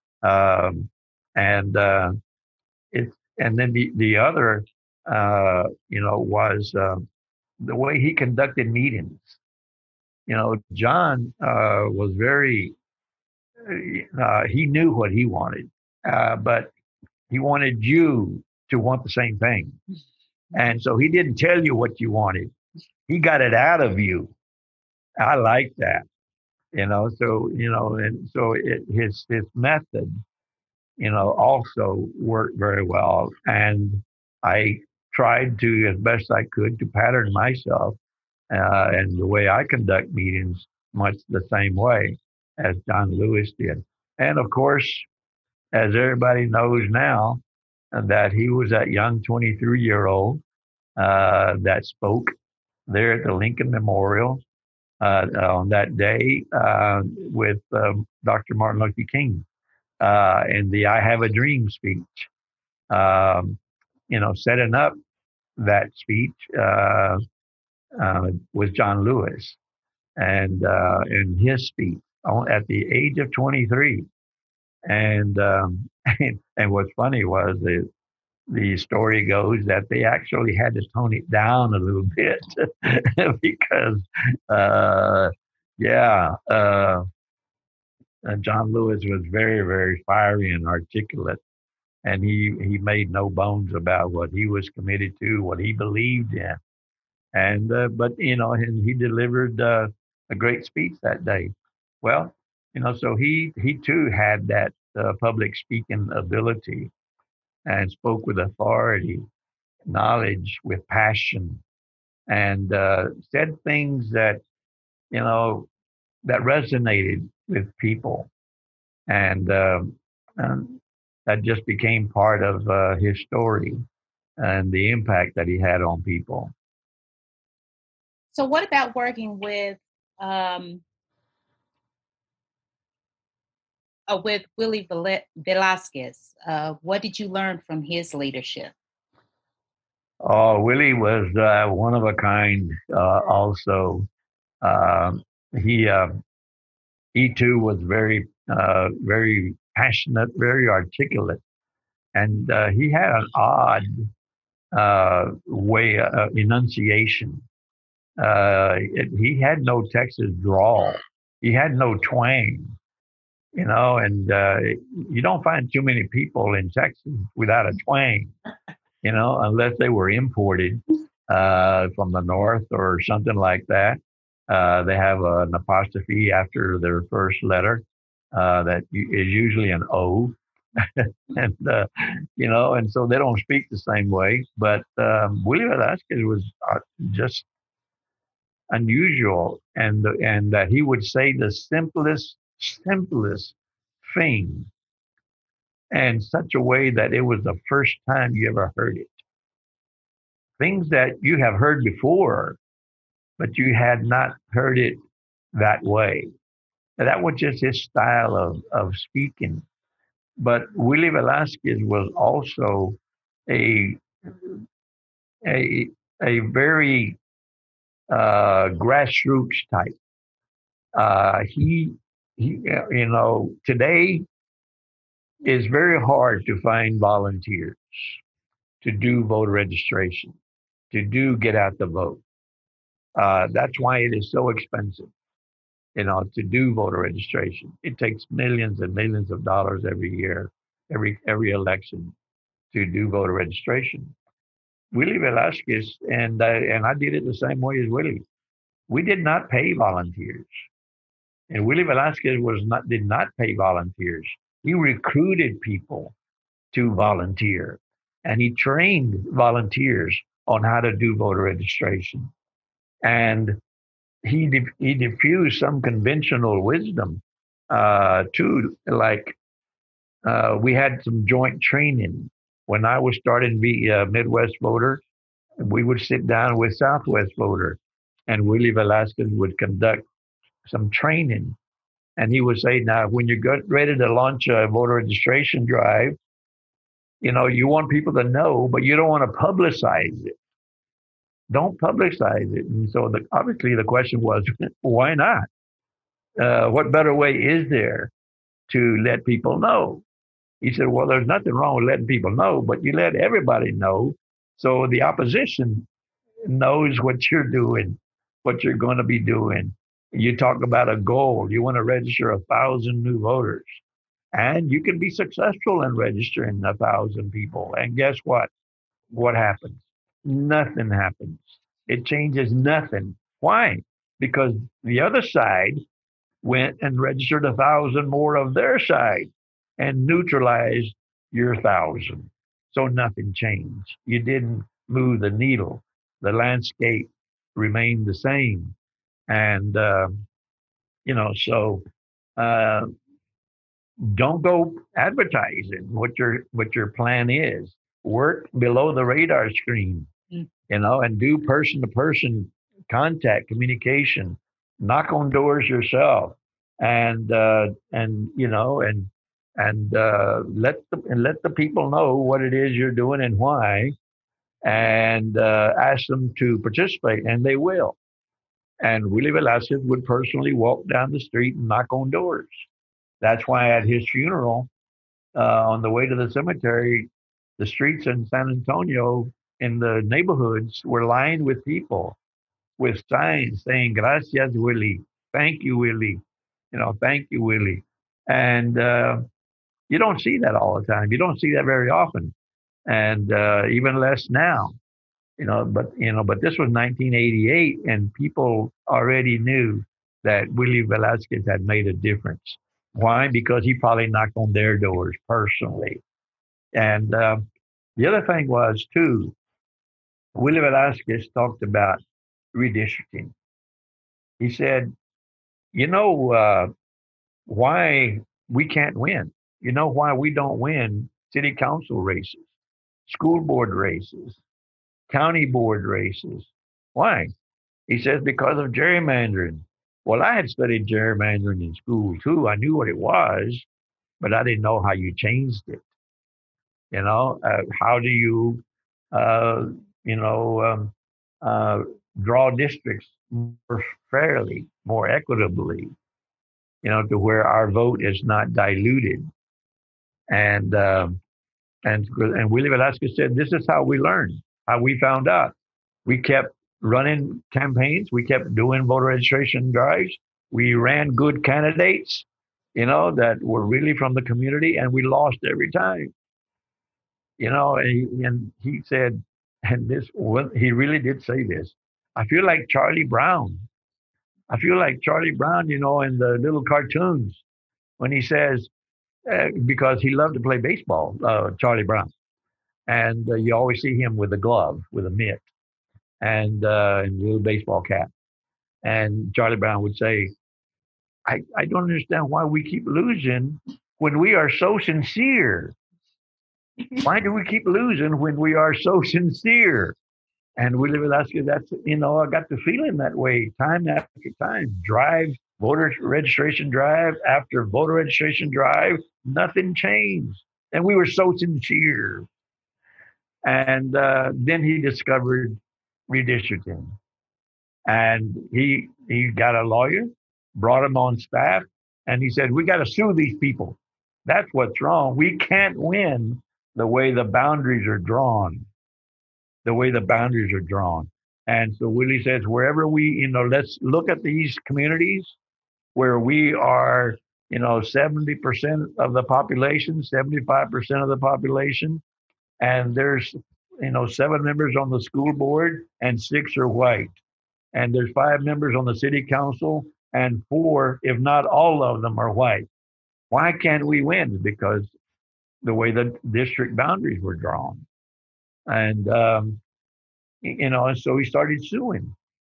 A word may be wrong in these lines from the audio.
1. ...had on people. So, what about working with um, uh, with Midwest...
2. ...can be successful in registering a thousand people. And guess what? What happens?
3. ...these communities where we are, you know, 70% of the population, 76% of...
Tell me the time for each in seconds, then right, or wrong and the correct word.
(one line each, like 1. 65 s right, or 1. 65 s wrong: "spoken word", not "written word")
1. 125 s wrong: "Willie", not "Midwest"
2. 314 s right
3. 534 s wrong: "75", not "76".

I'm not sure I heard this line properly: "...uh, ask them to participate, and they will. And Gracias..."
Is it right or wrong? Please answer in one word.
wrong.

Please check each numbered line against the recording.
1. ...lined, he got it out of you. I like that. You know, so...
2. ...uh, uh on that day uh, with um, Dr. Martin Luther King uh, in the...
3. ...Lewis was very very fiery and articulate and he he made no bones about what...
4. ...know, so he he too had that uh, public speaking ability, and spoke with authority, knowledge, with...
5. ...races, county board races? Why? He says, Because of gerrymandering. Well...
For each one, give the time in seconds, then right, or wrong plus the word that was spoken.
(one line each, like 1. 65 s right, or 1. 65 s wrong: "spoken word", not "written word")
1. 22 s wrong: "wanted", not "lined"
2. 54 s right
3. 88 s right
4. 102 s right
5. 423 s right.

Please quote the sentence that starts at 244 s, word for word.
Willie Velasquez and I, and I did it the same way as Willie.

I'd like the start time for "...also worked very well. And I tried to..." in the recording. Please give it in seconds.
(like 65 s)
31 s.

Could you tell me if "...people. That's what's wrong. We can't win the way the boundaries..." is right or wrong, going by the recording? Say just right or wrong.
right.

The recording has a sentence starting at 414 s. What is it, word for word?
He said, You know uh, why we can't win?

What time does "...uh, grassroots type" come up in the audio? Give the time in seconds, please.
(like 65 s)
218 s.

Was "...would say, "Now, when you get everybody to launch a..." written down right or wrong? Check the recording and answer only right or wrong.
wrong.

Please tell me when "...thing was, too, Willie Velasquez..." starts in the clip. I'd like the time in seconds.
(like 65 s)
408 s.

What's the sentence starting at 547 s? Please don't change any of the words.
And there's five members on the city council and four, if not all of them, are white.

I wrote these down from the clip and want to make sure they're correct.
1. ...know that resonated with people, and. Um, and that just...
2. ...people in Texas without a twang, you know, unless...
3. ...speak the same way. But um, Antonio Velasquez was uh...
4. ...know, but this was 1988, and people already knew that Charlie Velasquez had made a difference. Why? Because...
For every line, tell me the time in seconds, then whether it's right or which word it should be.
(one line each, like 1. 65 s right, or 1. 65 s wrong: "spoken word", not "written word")
1. 115 s right
2. 166 s right
3. 183 s wrong: "Willie", not "Antonio"
4. 396 s wrong: "Willie", not "Charlie".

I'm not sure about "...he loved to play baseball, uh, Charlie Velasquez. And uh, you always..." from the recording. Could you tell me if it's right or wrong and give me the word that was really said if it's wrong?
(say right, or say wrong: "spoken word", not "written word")
wrong: "Brown", not "Velasquez".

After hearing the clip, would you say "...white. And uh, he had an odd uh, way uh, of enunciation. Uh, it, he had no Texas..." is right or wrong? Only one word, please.
wrong.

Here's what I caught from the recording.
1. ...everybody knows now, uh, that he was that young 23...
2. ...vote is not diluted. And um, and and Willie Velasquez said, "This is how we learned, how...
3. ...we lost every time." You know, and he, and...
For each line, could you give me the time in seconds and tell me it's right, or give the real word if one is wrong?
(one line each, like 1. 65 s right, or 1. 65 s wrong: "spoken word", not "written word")
1. 45 s right
2. 447 s right
3. 464 s right.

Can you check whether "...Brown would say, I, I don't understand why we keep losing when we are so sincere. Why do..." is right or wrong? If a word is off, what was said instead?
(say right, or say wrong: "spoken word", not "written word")
right.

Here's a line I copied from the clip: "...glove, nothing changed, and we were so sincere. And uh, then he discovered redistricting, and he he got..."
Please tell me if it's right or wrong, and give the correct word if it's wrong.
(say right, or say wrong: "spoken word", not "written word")
wrong: "drive", not "glove".